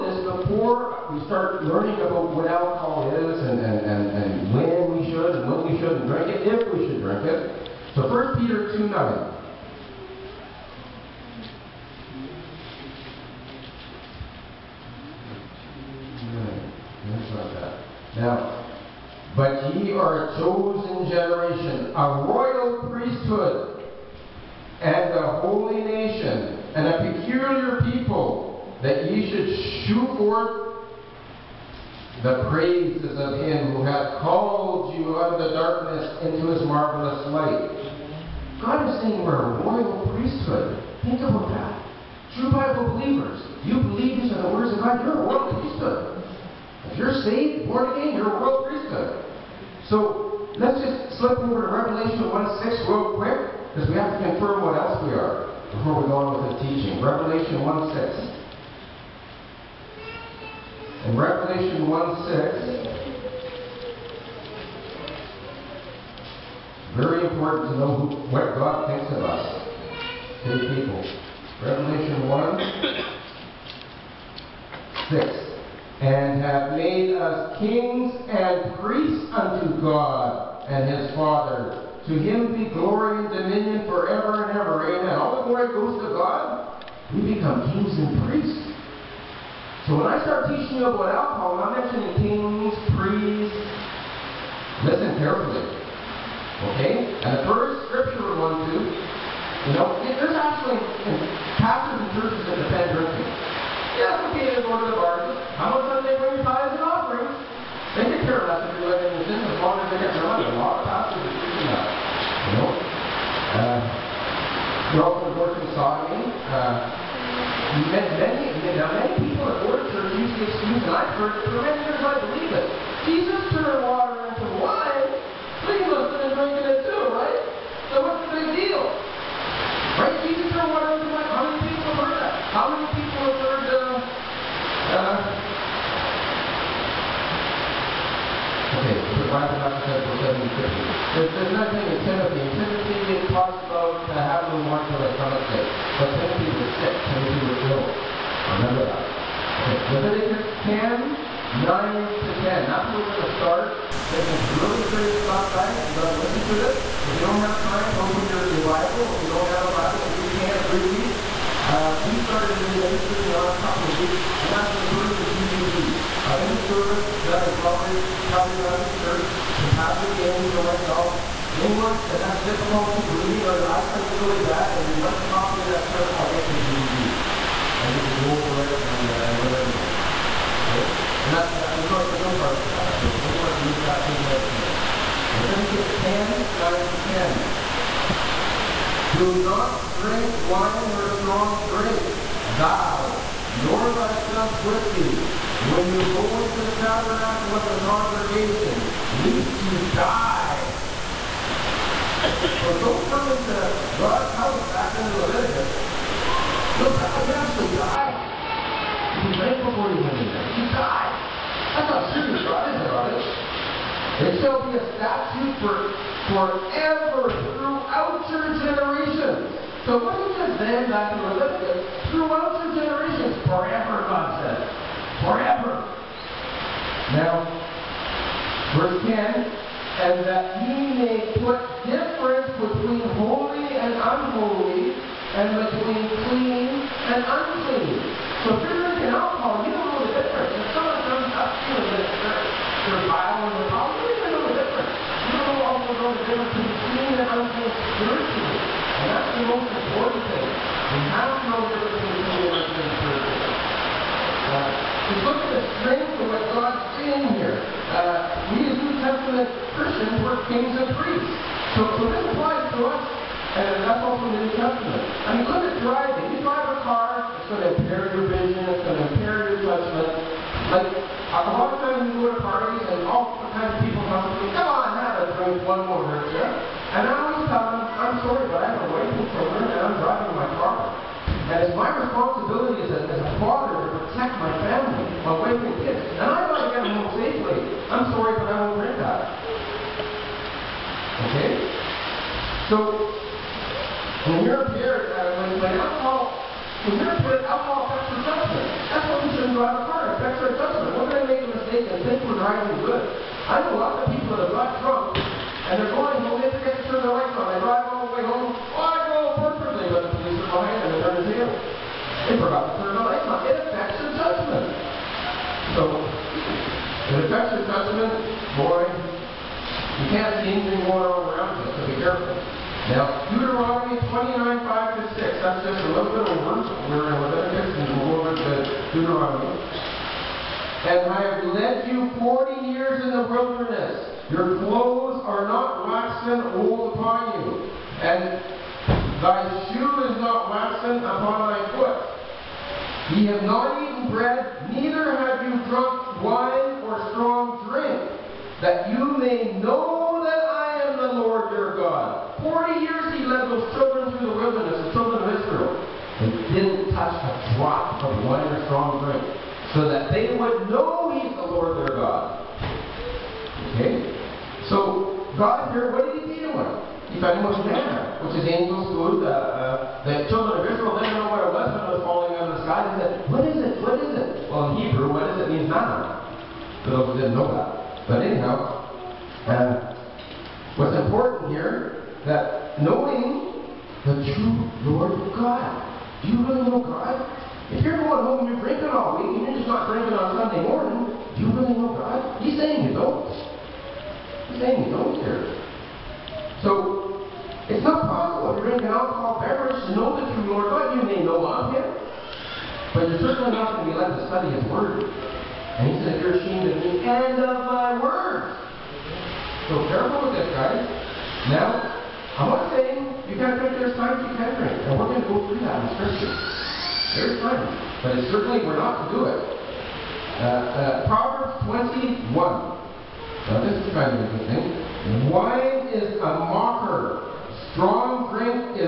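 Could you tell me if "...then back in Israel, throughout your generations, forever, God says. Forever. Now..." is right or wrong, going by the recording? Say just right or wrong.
wrong.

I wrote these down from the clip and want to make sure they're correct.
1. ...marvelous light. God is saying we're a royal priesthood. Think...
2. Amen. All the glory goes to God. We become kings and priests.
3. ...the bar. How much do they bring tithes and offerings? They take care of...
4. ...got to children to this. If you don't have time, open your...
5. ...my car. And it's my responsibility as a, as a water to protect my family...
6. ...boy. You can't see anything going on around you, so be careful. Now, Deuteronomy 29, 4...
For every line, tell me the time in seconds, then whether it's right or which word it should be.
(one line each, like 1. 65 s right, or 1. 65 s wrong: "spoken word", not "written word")
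1. 36 s right
2. 84 s right
3. 104 s right
4. 155 s wrong: "listen", not "children"
5. 280 s wrong: "father", not "water"
6. 318 s wrong: "5", not "4".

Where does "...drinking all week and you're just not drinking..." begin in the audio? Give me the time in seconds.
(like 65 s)
388 s.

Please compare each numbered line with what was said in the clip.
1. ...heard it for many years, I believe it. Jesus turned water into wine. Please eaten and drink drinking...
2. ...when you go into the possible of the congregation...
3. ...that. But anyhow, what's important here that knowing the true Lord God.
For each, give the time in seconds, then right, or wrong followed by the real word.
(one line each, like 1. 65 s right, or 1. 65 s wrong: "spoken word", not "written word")
1. 121 s wrong: "listen", not "eaten"
2. 195 s wrong: "tabernacle", not "possible"
3. 377 s right.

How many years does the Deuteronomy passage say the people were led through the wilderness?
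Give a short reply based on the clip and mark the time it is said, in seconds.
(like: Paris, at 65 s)
40, at 332 s.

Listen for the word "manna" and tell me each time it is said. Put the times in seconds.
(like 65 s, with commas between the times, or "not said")
367 s, 375 s.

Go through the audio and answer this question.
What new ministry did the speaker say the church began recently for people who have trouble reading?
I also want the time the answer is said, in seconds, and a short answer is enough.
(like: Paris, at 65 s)
the word of DVD, at 164 s.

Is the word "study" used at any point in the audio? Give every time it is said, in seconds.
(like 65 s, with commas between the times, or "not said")
404 s.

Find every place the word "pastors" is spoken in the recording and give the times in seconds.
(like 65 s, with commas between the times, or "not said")
101 s, 110 s, 169 s.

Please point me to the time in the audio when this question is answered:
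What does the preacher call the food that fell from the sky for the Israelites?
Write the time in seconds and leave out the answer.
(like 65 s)
368 s.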